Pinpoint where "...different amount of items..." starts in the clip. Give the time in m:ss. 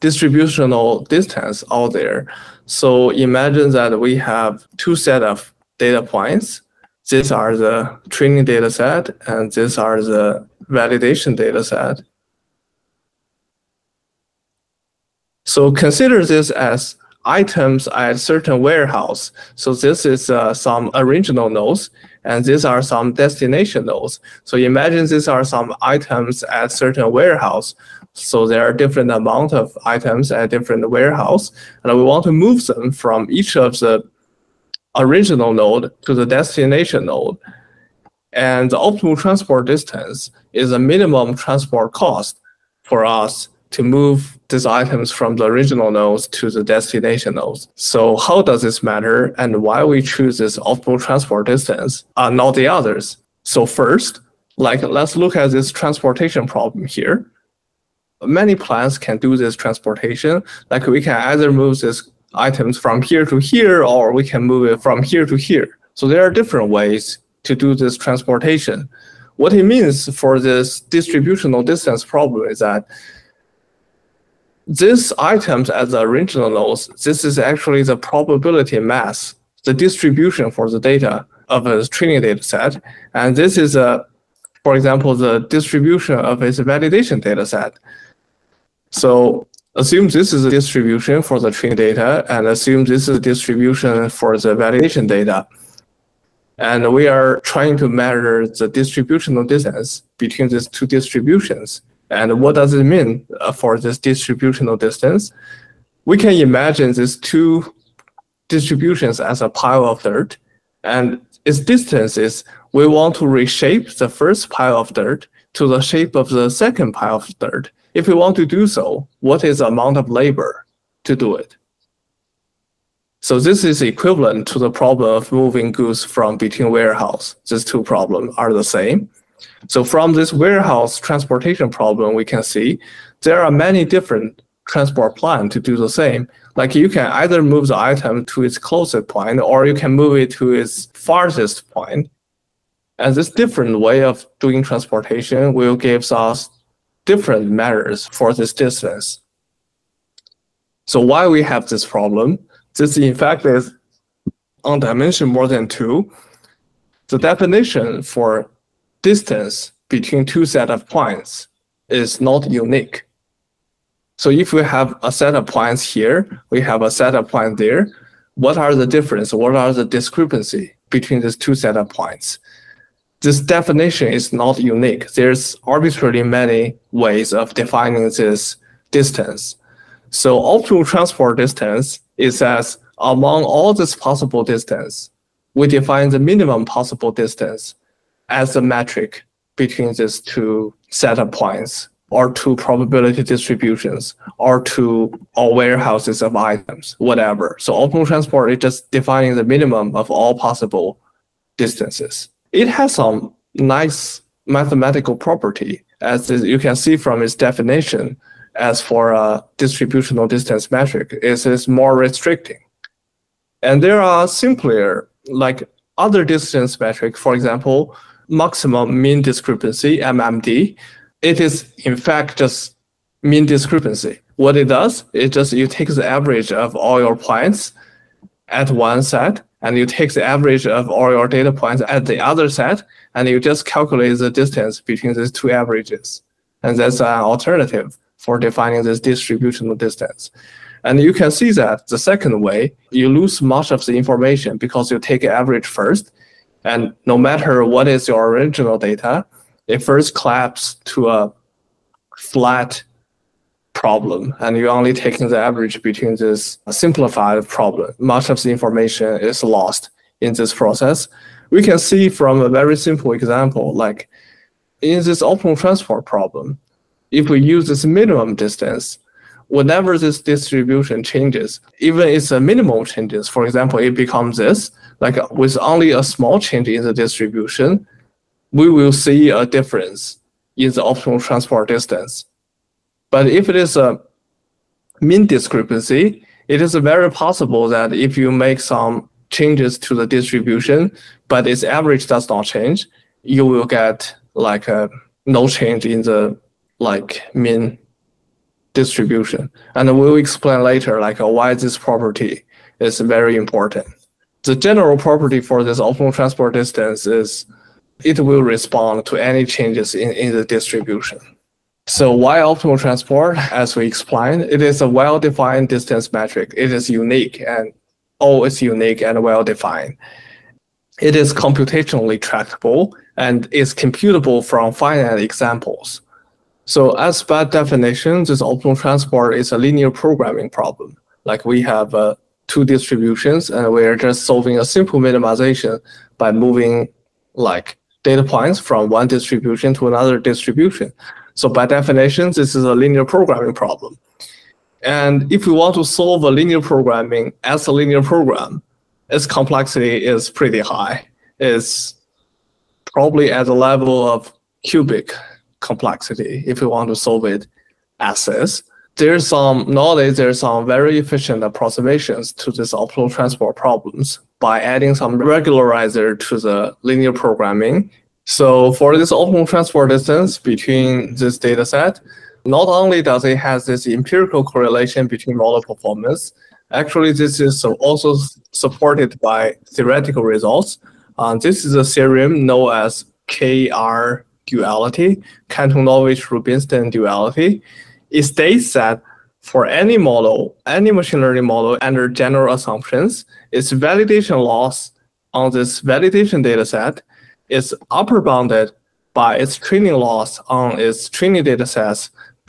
0:28.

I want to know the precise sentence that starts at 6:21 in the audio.
Uh, this is a theorem known as KR duality, Kantorovich-Rubinstein duality.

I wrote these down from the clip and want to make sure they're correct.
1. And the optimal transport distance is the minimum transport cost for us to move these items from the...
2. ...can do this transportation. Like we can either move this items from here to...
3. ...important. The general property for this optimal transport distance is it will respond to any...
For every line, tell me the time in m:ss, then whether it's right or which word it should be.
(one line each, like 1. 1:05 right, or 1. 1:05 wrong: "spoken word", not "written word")
1. 0:38 right
2. 0:58 right
3. 5:03 right.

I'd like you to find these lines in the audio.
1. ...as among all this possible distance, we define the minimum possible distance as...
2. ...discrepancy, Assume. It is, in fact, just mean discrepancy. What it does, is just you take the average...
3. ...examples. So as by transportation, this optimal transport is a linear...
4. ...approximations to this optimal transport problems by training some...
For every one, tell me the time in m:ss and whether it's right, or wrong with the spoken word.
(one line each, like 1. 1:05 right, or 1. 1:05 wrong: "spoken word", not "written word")
1. 3:02 right
2. 3:39 wrong: "MMD", not "Assume"
3. 5:25 wrong: "definition", not "transportation"
4. 6:01 wrong: "adding", not "training".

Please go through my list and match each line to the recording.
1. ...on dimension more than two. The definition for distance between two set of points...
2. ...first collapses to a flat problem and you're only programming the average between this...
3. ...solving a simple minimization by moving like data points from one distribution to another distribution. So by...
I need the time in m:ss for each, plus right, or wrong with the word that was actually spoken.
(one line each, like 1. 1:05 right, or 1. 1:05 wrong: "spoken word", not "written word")
1. 2:34 right
2. 4:09 wrong: "taking", not "programming"
3. 5:34 right.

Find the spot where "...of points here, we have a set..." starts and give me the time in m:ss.
2:45.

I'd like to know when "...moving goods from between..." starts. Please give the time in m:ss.
2:05.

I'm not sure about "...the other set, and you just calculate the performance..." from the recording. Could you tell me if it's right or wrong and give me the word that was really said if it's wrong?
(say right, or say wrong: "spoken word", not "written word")
wrong: "distance", not "performance".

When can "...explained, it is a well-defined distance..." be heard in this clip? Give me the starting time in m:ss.
5:13.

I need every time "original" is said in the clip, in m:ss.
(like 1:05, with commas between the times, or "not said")
0:20, 0:34, 0:45, 1:16, 4:08.